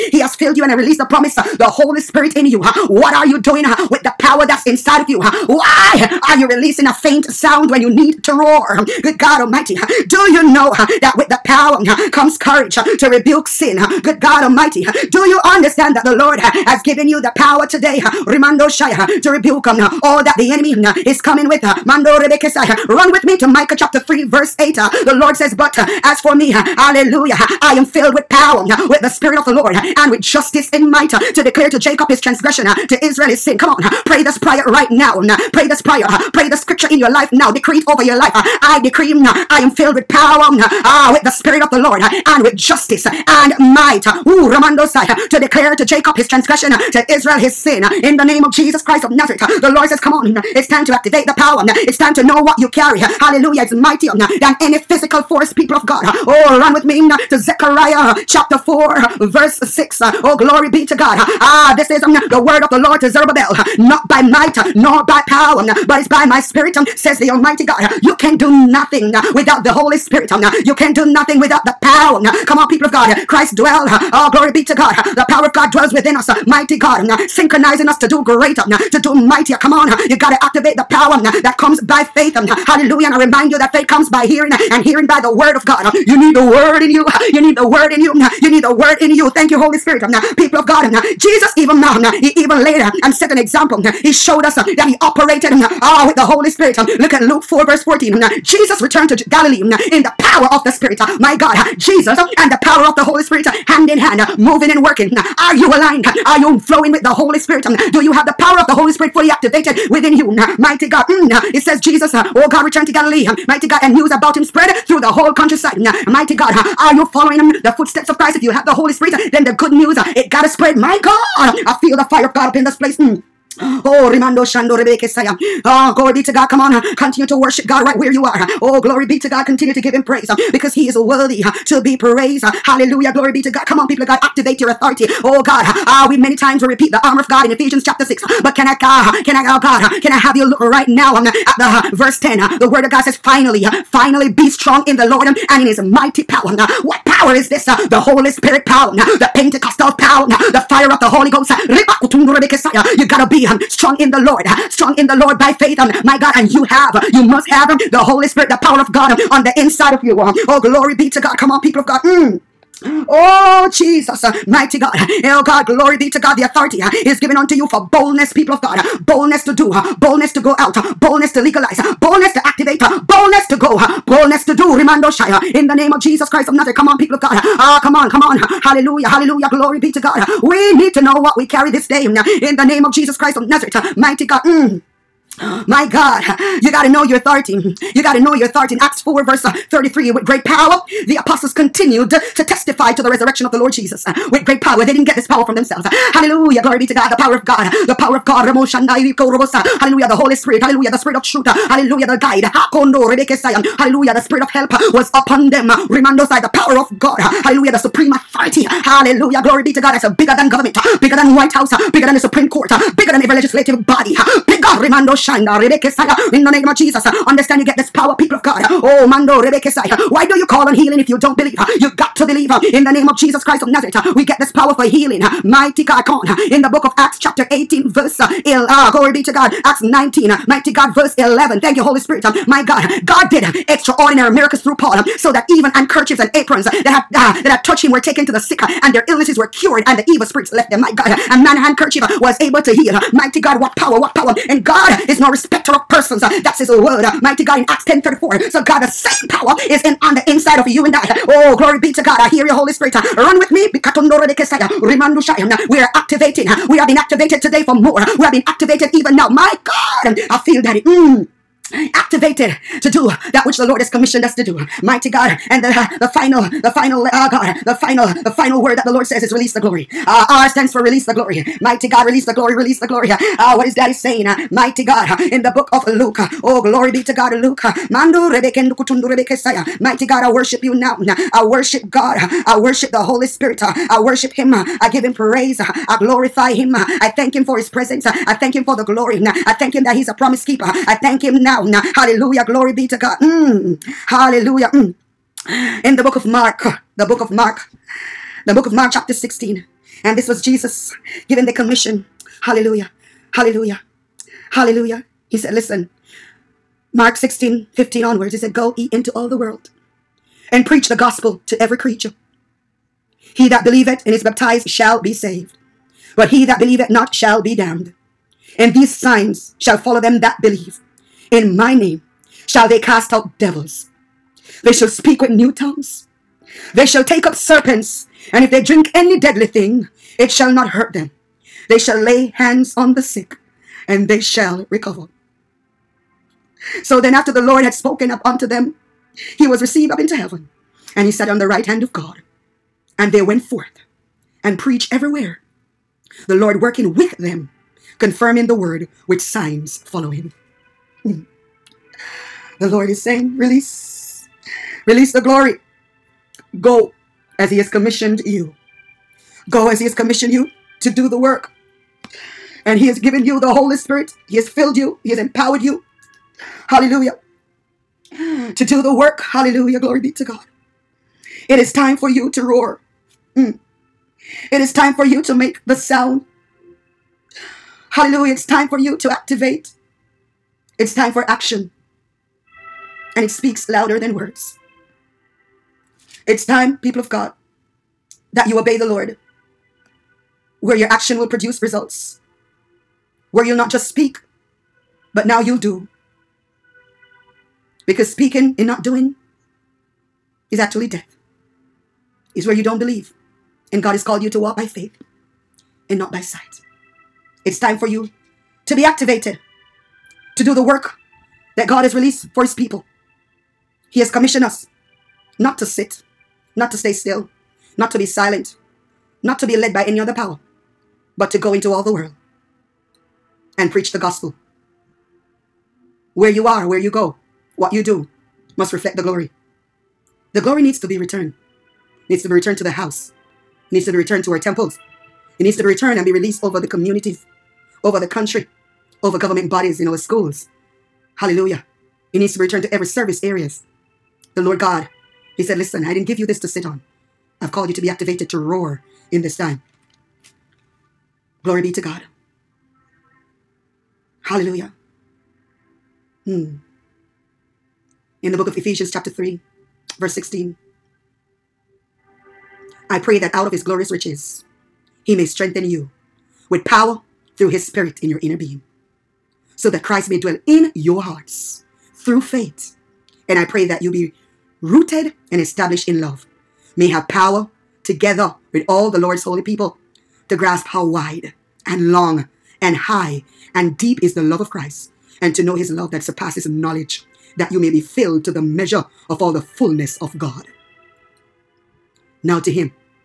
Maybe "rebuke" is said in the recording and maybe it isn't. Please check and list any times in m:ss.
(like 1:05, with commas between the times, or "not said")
0:13, 0:19.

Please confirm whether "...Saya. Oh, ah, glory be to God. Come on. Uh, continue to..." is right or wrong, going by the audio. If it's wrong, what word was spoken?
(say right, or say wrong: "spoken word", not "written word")
right.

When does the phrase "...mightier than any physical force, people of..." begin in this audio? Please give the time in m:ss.
0:53.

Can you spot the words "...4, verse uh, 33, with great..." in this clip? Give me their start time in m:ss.
3:08.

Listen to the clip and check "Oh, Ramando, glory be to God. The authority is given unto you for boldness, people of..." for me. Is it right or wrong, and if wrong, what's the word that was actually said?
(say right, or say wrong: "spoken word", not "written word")
wrong: "God", not "Ramando".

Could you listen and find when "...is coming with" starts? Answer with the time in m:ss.
0:21.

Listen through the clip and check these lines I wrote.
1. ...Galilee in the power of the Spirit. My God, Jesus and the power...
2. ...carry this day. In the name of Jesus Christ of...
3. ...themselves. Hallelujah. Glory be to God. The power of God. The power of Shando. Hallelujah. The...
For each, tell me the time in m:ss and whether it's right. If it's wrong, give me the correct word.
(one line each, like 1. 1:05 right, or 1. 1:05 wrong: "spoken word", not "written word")
1. 1:39 right
2. 3:01 right
3. 3:15 wrong: "God", not "Shando".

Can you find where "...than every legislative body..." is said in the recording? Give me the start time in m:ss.
3:33.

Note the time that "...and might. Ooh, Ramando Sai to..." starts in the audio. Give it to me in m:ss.
0:43.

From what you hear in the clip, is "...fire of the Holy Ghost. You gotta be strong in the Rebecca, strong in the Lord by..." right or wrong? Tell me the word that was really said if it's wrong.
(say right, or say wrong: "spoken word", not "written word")
wrong: "Lord", not "Rebecca".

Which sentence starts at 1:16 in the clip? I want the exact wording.
Mighty God, synchronizing us to do greater, to do mightier.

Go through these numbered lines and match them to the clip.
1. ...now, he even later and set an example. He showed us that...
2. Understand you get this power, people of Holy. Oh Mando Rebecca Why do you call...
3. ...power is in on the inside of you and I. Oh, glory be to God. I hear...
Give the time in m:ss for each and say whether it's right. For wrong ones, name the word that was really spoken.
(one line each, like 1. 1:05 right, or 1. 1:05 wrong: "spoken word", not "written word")
1. 1:31 right
2. 3:37 wrong: "God", not "Holy"
3. 4:09 right.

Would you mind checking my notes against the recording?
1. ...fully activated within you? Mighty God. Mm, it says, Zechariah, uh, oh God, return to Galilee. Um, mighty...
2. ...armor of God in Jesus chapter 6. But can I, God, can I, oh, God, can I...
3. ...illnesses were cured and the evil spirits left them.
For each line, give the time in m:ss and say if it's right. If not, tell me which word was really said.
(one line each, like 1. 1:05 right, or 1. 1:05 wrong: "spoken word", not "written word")
1. 1:49 wrong: "Jesus", not "Zechariah"
2. 2:17 wrong: "Ephesians", not "Jesus"
3. 3:59 right.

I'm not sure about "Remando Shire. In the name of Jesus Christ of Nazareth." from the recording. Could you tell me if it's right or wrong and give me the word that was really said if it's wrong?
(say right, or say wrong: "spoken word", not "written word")
right.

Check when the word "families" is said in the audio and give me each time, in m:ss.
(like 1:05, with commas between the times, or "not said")
not said.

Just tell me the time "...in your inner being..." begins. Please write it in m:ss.
7:48.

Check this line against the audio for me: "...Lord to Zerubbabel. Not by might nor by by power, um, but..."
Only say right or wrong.
right.